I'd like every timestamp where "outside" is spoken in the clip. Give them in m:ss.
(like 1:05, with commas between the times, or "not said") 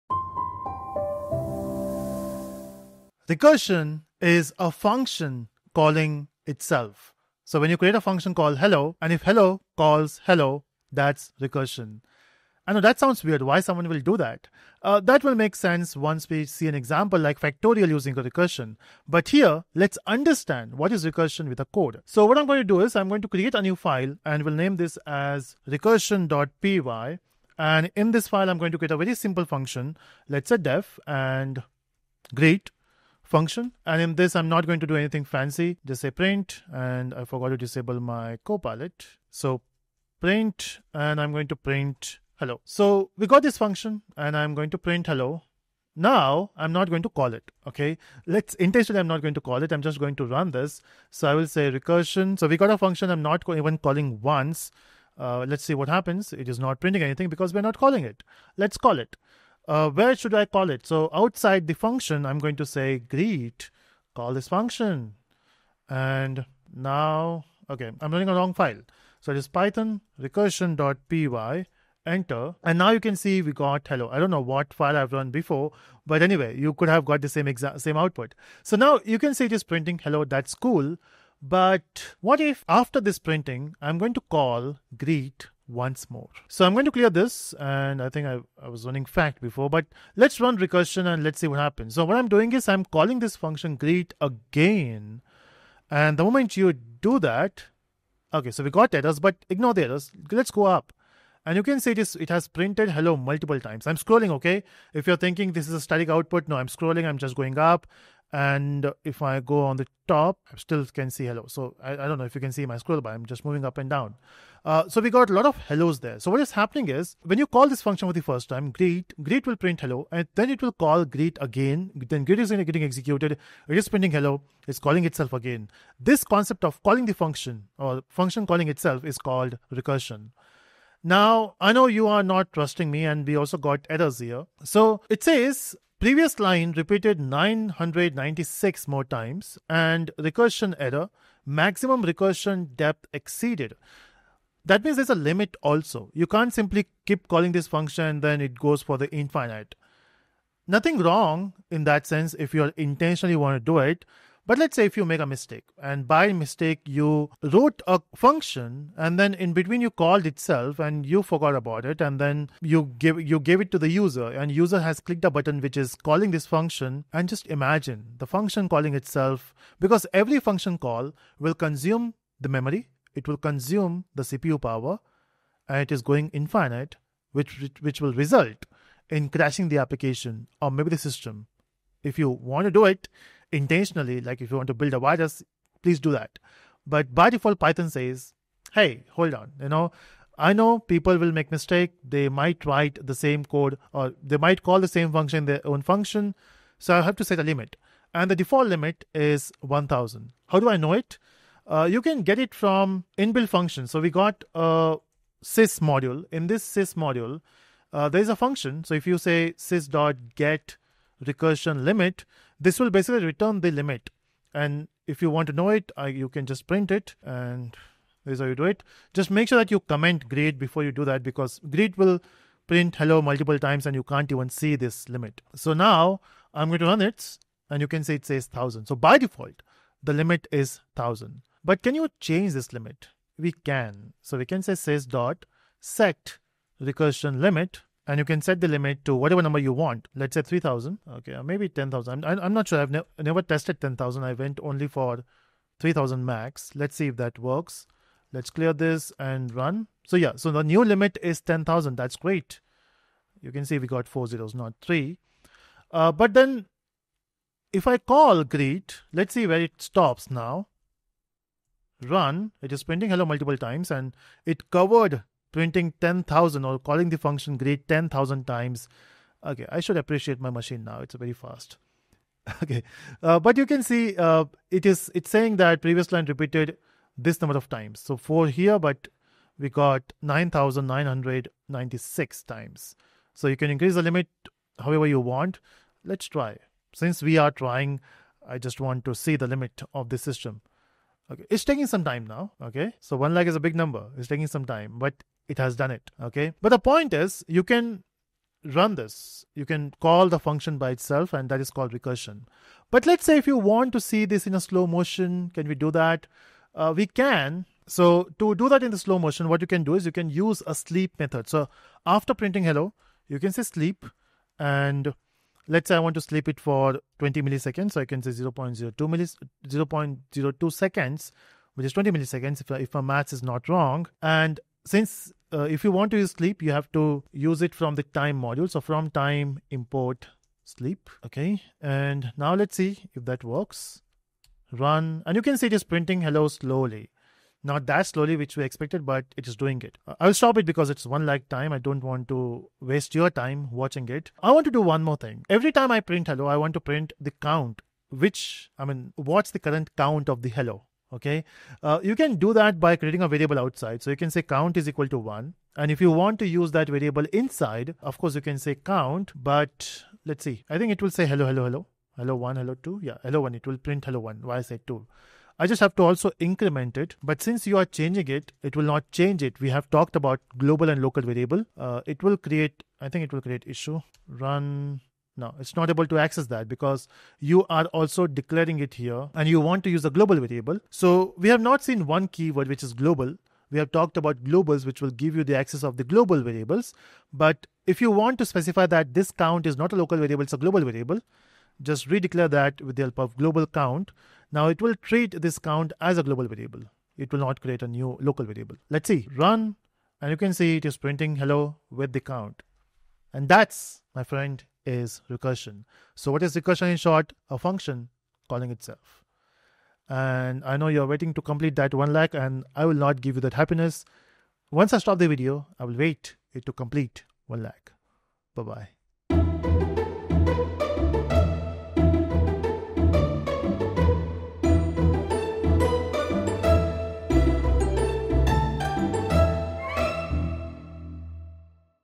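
1:01, 5:53.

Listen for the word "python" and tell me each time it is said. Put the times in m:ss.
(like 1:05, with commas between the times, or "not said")
1:09, 3:07.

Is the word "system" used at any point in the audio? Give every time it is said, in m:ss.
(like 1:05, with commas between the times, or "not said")
3:00, 4:50.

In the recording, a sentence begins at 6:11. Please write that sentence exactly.
Uh, it will create, I think it will create issue.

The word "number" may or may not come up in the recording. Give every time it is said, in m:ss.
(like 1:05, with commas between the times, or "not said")
3:59, 4:37, 4:53.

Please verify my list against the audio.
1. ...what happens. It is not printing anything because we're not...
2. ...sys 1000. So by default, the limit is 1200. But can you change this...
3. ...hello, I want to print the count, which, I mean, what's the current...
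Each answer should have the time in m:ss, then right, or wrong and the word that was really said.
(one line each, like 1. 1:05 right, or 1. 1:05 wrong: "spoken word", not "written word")
1. 0:55 right
2. 3:48 wrong: "1000", not "1200"
3. 5:46 right.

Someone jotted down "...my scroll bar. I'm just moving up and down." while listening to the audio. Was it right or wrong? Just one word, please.
right.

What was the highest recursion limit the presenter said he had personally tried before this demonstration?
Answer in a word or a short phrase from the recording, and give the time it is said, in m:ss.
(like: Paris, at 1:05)
3000, at 4:05.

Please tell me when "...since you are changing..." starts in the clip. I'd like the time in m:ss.
6:07.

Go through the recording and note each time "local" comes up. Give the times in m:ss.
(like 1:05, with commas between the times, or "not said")
6:11, 6:29, 6:38.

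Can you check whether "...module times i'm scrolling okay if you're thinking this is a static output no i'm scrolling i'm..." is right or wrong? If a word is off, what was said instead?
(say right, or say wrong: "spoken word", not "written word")
wrong: "multiple", not "module".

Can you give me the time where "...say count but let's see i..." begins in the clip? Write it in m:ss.
5:58.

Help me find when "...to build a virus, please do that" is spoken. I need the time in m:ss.
3:04.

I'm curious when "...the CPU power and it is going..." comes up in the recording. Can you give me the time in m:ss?
2:54.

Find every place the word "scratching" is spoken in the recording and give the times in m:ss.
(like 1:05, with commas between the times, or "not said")
not said.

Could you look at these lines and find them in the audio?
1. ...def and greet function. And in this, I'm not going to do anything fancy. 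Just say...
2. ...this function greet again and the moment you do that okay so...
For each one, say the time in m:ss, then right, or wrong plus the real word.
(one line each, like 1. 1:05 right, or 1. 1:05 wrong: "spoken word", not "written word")
1. 0:30 right
2. 1:33 right.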